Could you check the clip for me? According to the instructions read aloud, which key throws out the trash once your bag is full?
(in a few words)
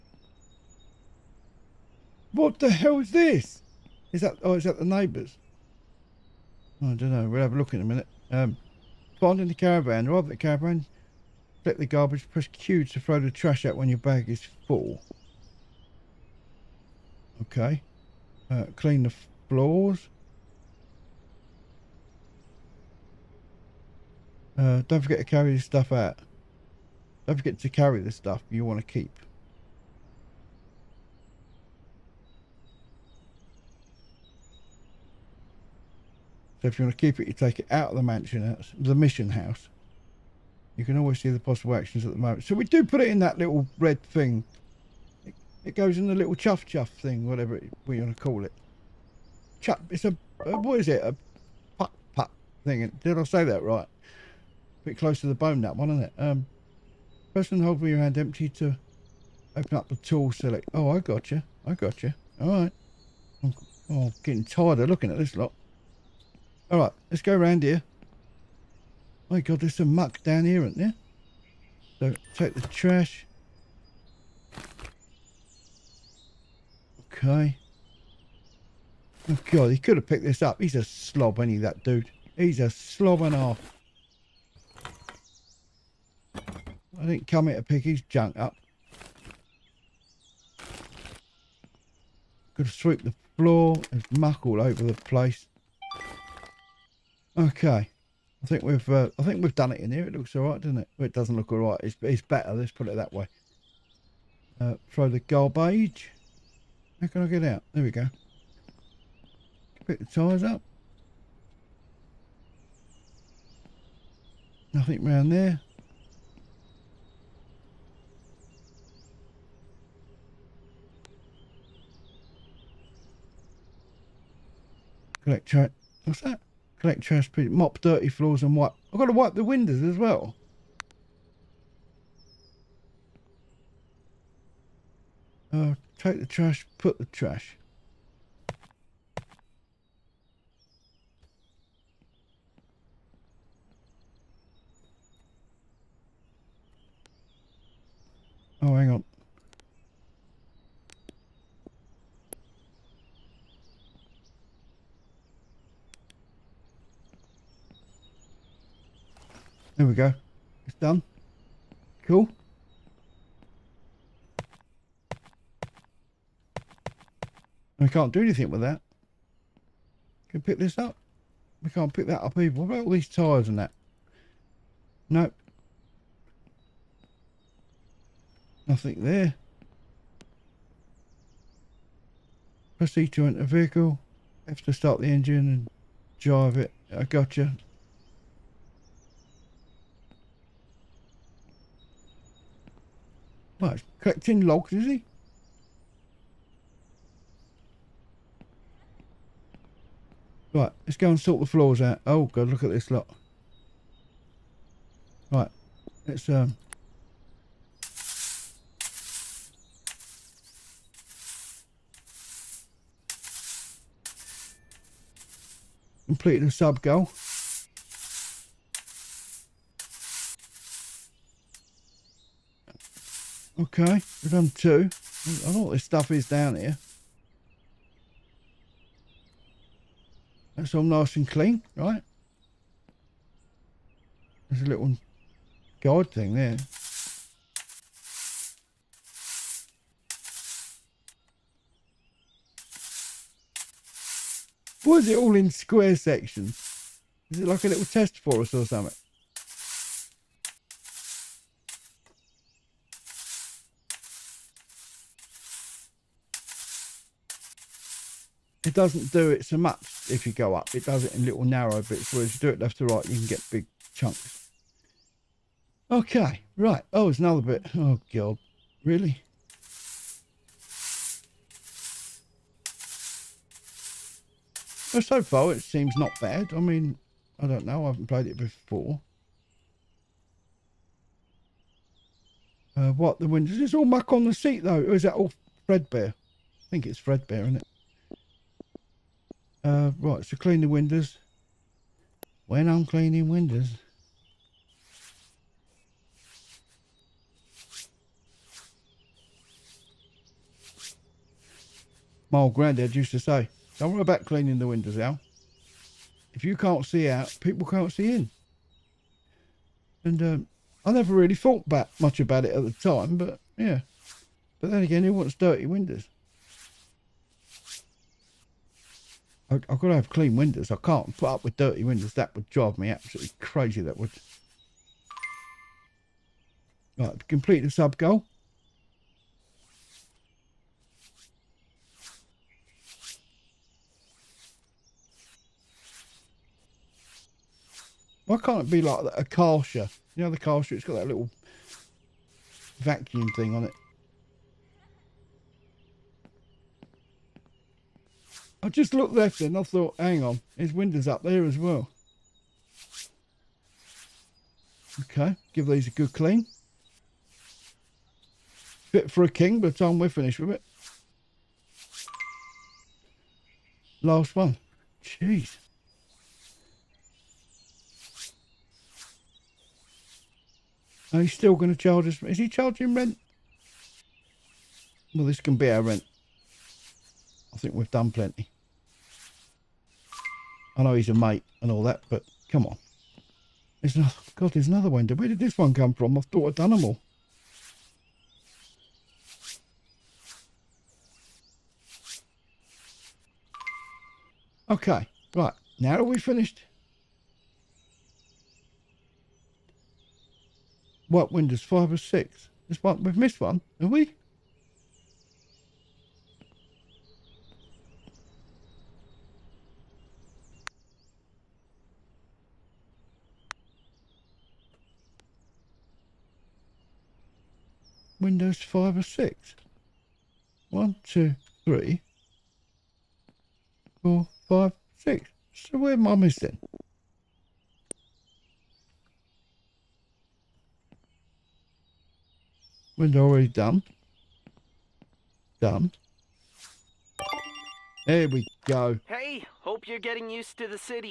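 Q.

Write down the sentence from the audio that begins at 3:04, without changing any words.
Have to start the engine and drive it.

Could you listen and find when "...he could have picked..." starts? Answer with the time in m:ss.
1:19.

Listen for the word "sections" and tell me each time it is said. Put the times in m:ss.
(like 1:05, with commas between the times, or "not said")
4:05.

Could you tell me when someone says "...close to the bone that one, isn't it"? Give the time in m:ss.
0:54.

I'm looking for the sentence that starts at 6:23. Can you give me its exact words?
There's another, God, there's another one.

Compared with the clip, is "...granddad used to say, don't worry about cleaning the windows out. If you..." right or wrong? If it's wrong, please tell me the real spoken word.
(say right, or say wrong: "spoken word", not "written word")
right.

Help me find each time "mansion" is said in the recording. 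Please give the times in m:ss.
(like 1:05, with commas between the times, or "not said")
0:38.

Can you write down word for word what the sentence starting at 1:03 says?
I'm, oh, I'm getting tired of looking at this lot.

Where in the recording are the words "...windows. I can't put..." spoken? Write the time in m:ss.
5:20.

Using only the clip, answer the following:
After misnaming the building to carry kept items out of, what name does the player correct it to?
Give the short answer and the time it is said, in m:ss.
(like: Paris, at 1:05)
mission house, at 0:38.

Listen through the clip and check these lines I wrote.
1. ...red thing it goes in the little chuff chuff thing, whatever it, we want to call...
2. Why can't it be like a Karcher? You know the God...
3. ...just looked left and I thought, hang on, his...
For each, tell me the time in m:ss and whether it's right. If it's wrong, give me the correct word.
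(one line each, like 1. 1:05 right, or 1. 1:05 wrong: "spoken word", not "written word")
1. 0:43 right
2. 5:38 wrong: "Karcher", not "God"
3. 5:48 right.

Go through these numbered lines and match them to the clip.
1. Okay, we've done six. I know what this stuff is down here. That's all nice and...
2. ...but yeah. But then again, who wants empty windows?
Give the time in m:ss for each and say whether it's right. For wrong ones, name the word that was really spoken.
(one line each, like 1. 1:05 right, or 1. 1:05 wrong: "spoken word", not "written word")
1. 3:43 wrong: "two", not "six"
2. 5:13 wrong: "dirty", not "empty".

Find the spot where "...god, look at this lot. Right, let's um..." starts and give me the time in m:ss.
3:22.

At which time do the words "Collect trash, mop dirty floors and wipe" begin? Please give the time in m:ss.
2:06.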